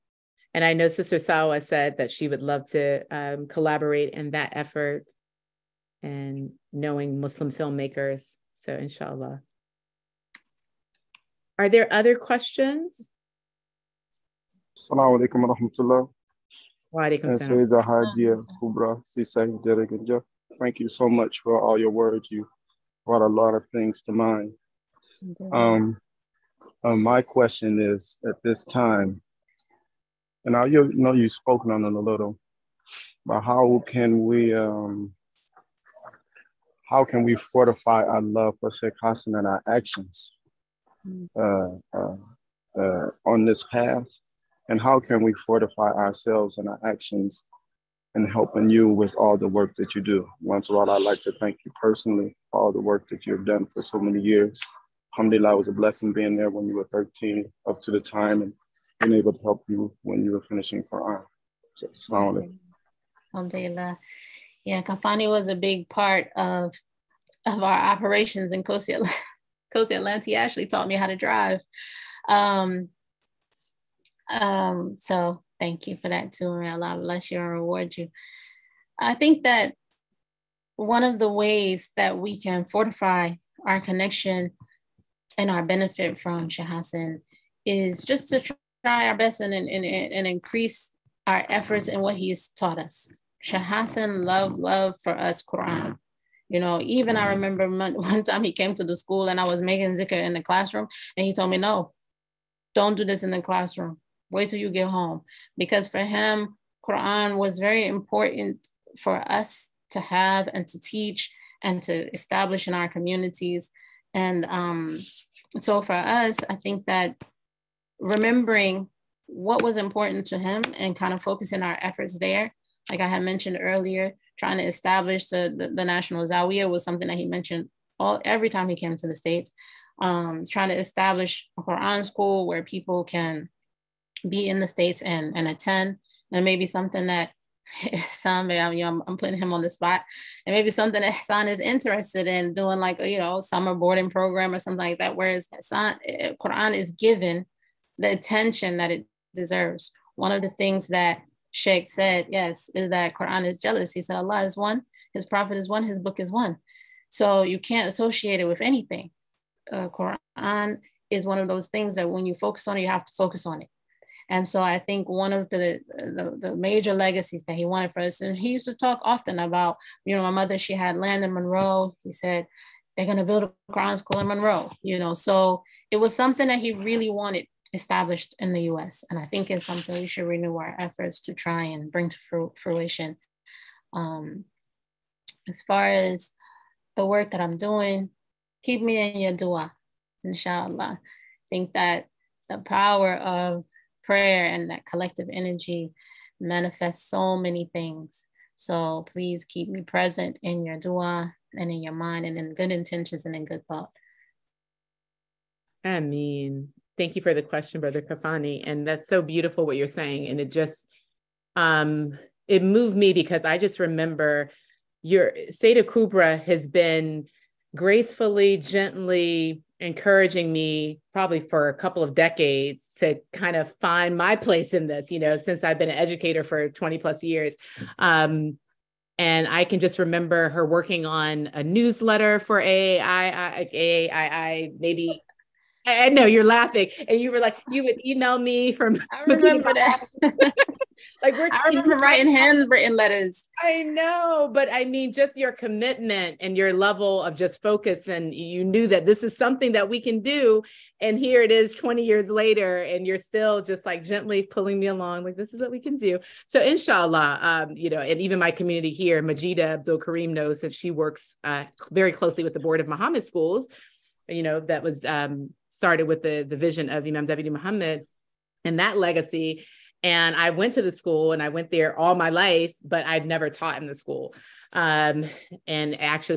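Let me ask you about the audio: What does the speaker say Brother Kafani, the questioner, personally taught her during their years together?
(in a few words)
How to drive.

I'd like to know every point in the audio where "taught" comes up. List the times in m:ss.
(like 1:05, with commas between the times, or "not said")
1:10, 1:32, 4:33.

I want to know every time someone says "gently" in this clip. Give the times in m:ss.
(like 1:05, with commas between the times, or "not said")
3:38, 4:14.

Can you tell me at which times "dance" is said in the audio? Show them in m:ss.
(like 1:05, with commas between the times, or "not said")
not said.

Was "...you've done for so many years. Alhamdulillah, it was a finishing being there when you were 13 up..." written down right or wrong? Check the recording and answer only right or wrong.
wrong.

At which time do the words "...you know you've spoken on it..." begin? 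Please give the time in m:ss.
0:30.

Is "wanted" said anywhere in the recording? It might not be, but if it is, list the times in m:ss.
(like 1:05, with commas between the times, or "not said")
2:47, 2:57.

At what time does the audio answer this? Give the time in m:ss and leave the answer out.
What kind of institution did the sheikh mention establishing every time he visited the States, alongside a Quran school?
2:05.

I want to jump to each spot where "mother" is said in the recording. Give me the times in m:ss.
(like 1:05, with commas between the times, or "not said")
2:50.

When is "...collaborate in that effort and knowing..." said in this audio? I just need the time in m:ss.
0:03.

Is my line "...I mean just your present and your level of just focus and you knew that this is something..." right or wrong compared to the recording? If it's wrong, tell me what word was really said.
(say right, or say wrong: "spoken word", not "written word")
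wrong: "commitment", not "present".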